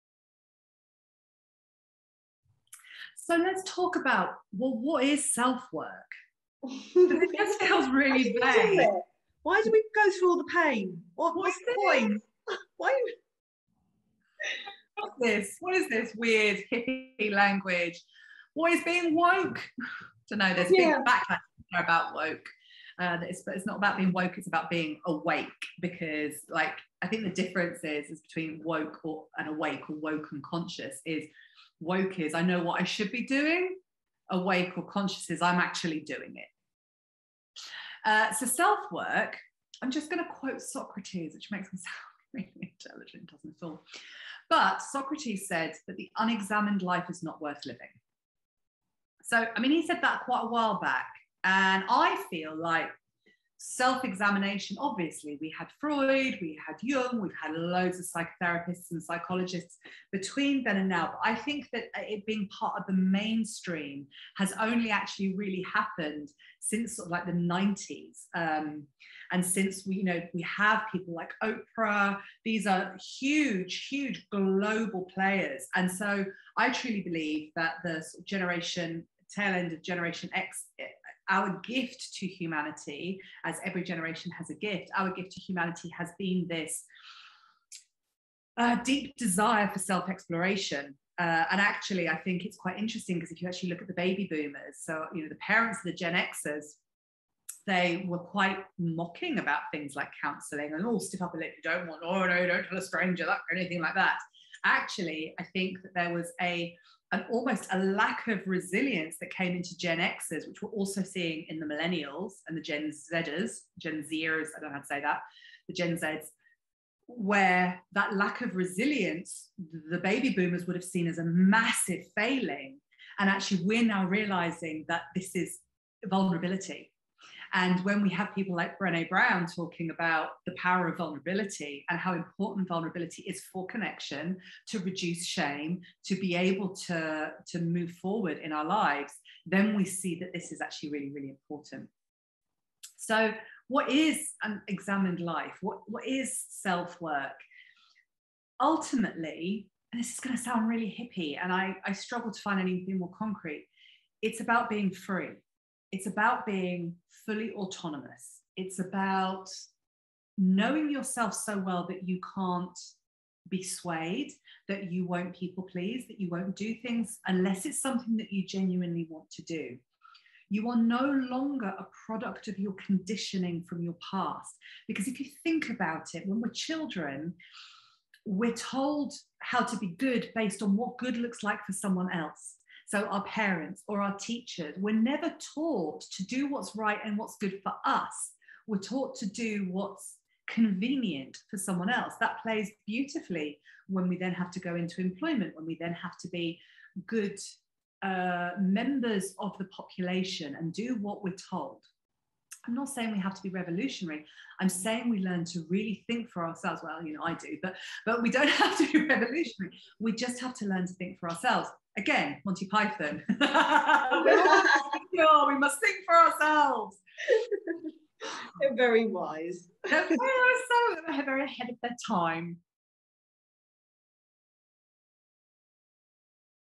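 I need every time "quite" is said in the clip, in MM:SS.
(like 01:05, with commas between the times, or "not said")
00:50, 01:32, 01:38.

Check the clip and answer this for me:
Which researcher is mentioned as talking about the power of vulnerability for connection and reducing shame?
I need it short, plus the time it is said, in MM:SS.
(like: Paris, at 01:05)
Brene Brown, at 02:08.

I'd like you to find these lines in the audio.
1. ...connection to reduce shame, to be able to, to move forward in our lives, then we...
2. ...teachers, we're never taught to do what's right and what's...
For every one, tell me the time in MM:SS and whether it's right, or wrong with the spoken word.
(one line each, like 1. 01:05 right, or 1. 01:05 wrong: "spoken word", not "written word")
1. 02:13 right
2. 03:04 right.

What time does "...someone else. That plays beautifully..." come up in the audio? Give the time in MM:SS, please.
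03:11.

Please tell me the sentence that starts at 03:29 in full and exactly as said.
We just have to learn to think for ourselves.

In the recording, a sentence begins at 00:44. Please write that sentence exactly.
But Socrates said that the unexamined life is not worth living.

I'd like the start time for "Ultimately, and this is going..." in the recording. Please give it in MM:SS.
02:28.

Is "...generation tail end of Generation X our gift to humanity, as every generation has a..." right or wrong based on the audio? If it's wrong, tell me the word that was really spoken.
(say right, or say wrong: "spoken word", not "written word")
right.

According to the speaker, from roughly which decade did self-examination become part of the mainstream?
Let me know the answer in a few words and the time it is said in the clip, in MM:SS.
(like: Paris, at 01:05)
the 90s, at 01:07.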